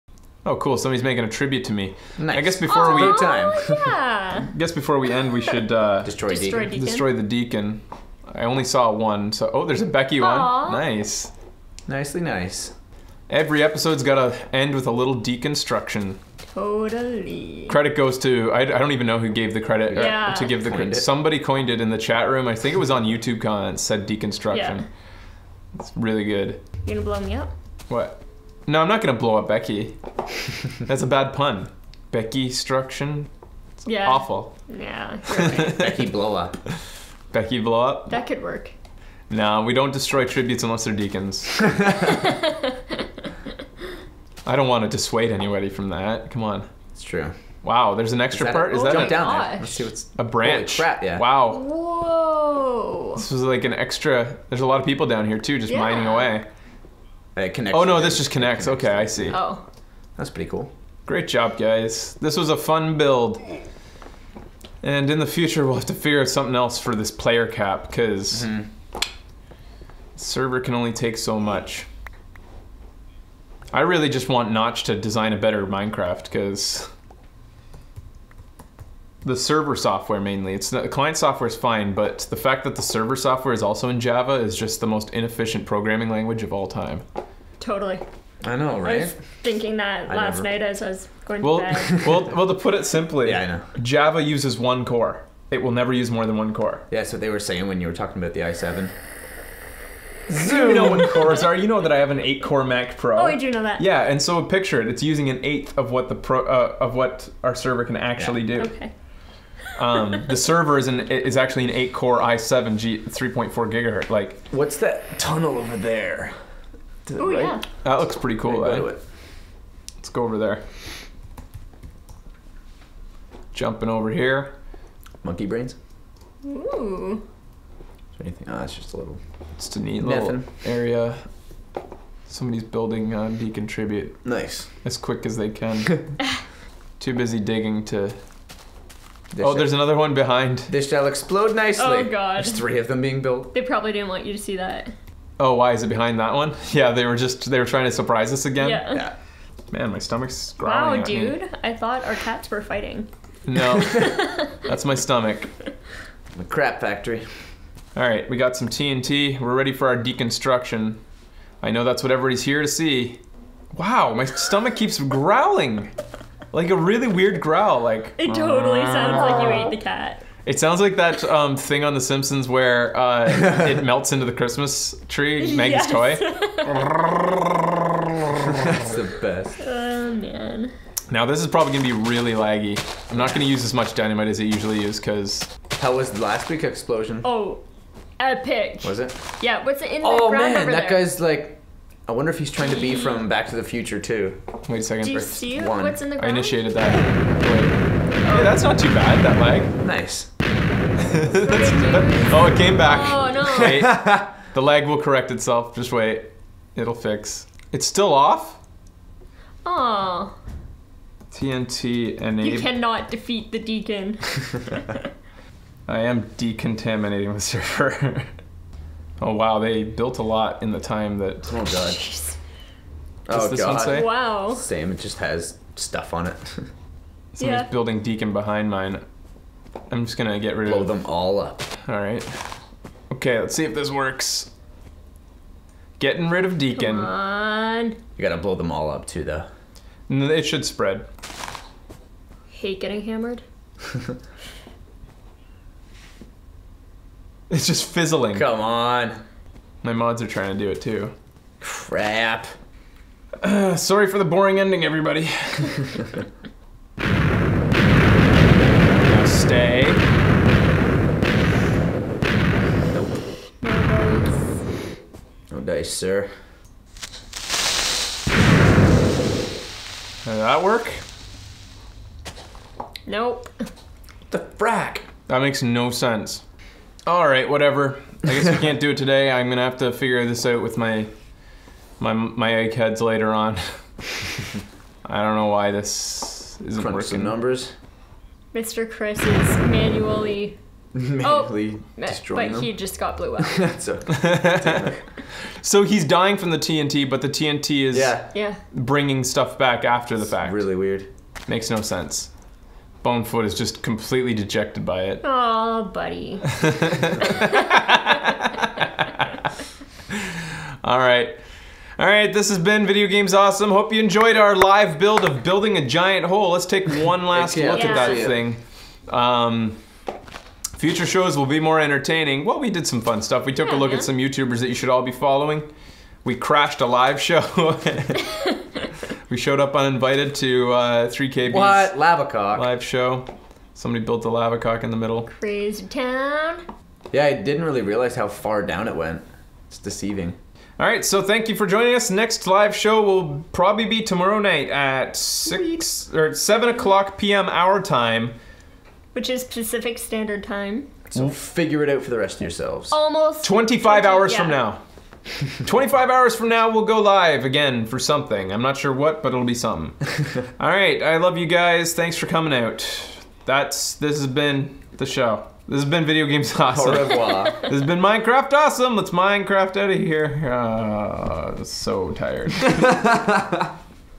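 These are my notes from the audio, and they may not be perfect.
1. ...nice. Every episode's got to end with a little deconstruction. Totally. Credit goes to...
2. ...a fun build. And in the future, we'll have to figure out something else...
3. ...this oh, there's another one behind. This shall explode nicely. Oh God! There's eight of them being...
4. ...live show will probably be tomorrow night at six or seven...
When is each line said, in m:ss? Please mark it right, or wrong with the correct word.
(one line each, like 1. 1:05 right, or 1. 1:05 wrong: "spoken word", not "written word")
1. 0:12 right
2. 1:02 right
3. 2:19 wrong: "three", not "eight"
4. 5:42 right.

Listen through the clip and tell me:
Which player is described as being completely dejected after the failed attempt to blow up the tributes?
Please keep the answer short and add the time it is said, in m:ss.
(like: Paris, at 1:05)
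Bonefoot, at 5:03.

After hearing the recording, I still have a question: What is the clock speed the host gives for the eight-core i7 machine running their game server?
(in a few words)
3.4 gigahertz.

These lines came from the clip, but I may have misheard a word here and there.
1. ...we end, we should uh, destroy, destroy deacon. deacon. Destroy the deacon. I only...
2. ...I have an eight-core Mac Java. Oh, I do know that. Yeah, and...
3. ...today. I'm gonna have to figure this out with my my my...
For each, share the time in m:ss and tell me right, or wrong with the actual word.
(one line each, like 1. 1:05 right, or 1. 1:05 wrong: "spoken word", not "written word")
1. 0:04 right
2. 1:41 wrong: "Pro", not "Java"
3. 4:38 right.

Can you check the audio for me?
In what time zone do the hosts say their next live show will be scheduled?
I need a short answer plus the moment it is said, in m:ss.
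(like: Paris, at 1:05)
Pacific Standard Time, at 5:49.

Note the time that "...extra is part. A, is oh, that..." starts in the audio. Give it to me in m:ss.
0:48.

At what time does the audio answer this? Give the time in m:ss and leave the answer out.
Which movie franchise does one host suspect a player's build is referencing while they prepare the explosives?
3:13.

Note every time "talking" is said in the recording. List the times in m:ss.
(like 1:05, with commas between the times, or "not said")
1:37.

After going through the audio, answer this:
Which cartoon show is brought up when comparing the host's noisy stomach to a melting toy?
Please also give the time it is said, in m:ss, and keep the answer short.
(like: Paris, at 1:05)
The Simpsons, at 2:51.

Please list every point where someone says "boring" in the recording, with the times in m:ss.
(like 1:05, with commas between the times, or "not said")
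4:14.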